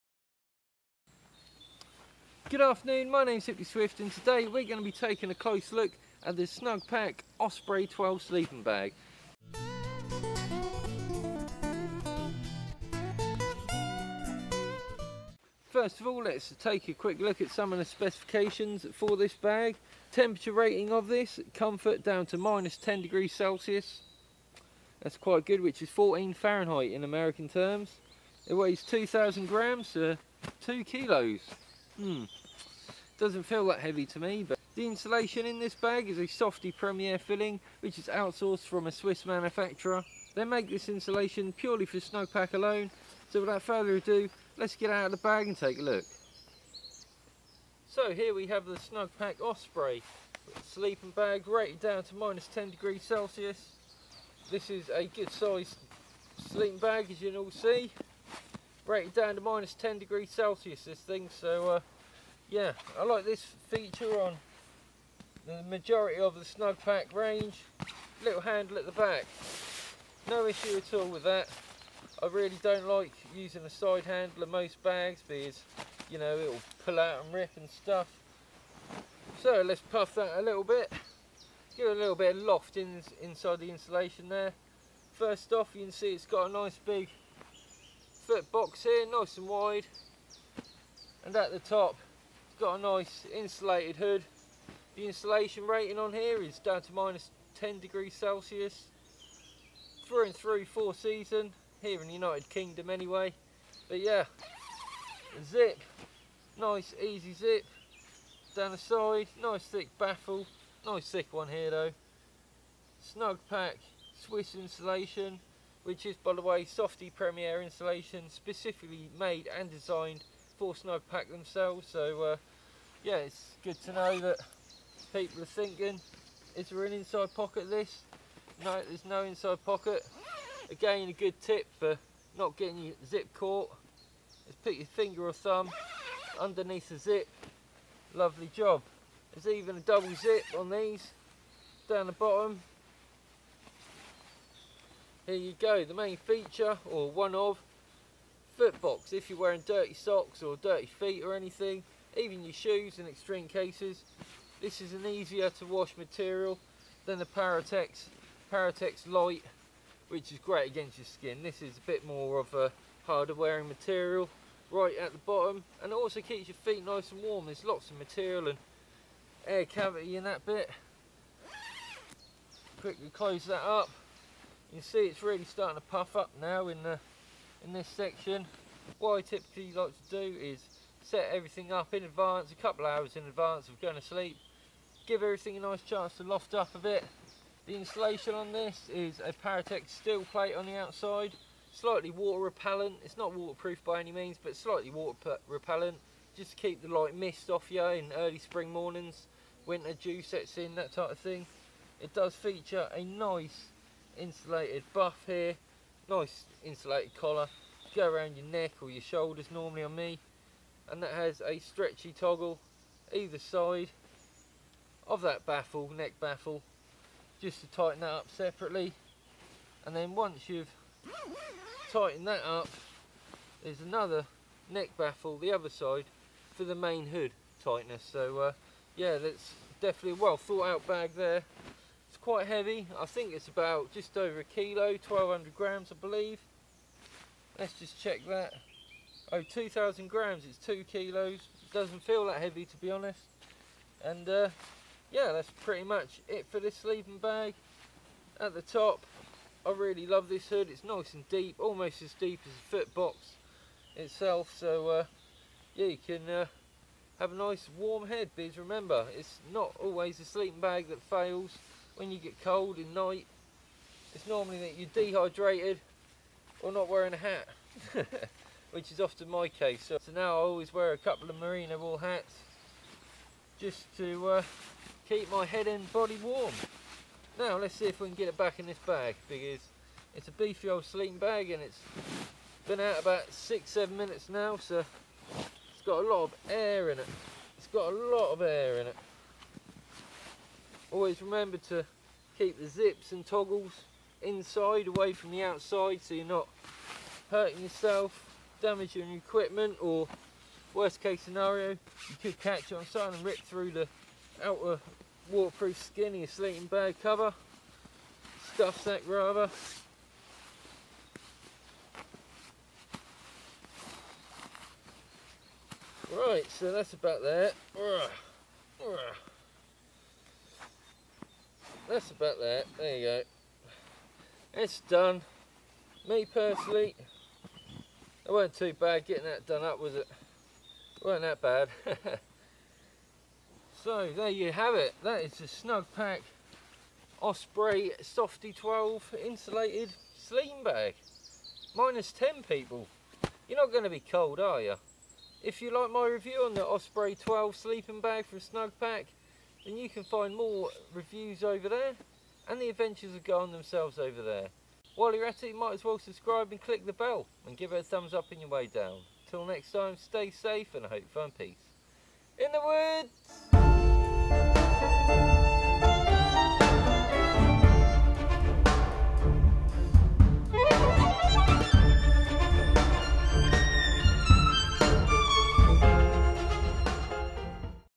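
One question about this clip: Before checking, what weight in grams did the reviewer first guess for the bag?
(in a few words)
1200 grams.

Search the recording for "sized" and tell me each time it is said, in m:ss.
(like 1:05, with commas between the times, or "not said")
0:55.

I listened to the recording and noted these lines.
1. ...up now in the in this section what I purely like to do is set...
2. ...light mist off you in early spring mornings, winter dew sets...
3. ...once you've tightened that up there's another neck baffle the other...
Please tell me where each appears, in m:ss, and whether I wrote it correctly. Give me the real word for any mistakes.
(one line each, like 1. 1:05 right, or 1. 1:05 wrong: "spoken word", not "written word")
1. 2:56 wrong: "typically", not "purely"
2. 3:16 right
3. 3:40 right.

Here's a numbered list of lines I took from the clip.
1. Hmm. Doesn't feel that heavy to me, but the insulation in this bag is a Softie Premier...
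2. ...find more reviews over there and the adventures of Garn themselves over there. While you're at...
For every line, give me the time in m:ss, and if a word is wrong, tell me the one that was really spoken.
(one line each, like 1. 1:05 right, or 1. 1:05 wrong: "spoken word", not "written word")
1. 0:31 right
2. 5:50 right.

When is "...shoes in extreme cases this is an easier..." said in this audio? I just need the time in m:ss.
2:32.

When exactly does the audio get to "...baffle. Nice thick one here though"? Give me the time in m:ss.
1:49.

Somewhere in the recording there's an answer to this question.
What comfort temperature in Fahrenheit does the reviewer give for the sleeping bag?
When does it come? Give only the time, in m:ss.
0:25.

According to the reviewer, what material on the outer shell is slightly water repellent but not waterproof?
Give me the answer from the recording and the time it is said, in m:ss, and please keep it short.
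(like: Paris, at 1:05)
Paratex Steelplate, at 3:09.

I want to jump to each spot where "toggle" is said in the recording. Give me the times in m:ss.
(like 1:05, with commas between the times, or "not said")
3:32, 4:53.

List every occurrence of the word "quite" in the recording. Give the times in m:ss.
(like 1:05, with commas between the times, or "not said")
0:25, 3:52.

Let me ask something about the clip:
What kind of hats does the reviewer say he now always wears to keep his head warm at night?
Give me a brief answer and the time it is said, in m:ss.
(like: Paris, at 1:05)
merino wool hats, at 4:31.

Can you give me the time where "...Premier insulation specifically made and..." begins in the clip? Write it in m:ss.
1:57.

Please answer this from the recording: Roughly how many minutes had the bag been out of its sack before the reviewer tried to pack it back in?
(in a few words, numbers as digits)
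6 or 7 minutes.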